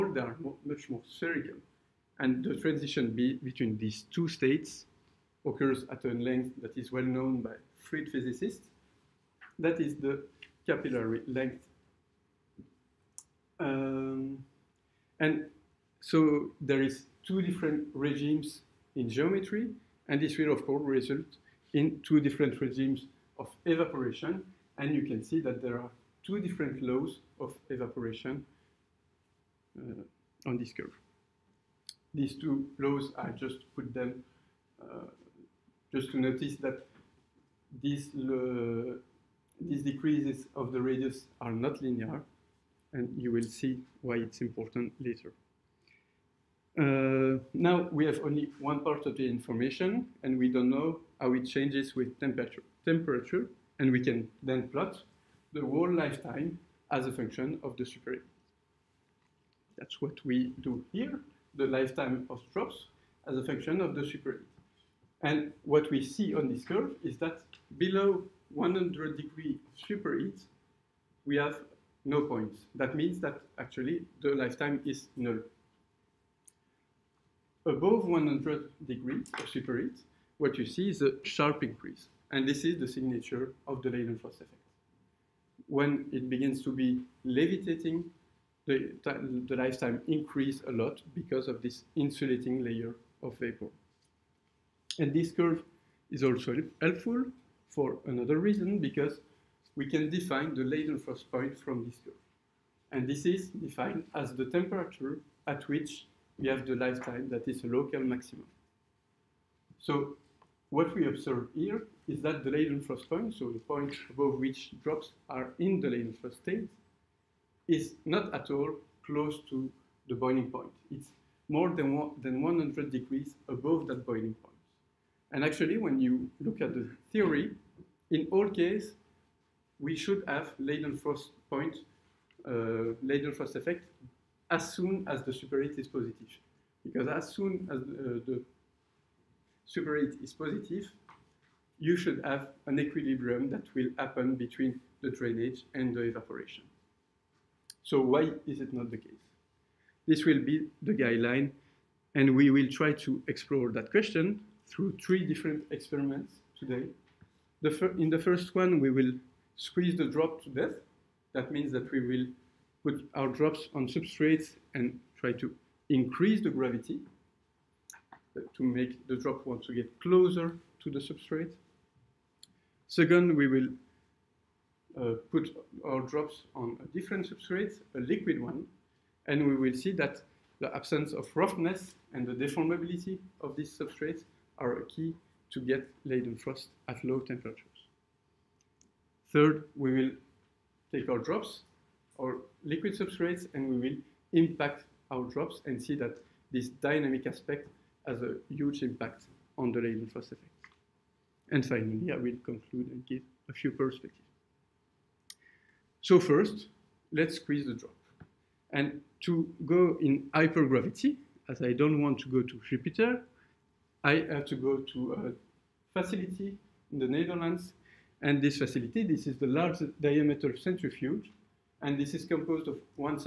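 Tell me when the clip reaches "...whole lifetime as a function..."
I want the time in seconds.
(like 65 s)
55 s.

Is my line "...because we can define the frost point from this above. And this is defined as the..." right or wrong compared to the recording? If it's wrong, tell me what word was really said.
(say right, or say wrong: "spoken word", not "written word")
wrong: "curve", not "above".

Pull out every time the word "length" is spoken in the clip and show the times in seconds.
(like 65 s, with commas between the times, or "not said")
6 s, 11 s.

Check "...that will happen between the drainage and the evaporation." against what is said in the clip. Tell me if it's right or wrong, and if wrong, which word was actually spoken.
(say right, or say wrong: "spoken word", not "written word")
right.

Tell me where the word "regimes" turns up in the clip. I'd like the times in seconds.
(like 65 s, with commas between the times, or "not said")
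17 s, 22 s.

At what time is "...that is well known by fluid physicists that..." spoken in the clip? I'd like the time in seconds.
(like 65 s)
6 s.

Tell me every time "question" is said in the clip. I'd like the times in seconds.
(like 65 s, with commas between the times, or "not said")
153 s.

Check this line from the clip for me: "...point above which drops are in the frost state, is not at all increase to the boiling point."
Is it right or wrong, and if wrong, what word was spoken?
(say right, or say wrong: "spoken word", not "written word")
wrong: "close", not "increase".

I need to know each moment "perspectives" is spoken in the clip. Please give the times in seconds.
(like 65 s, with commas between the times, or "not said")
203 s.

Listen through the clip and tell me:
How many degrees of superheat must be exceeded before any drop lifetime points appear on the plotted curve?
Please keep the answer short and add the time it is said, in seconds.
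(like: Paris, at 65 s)
100, at 68 s.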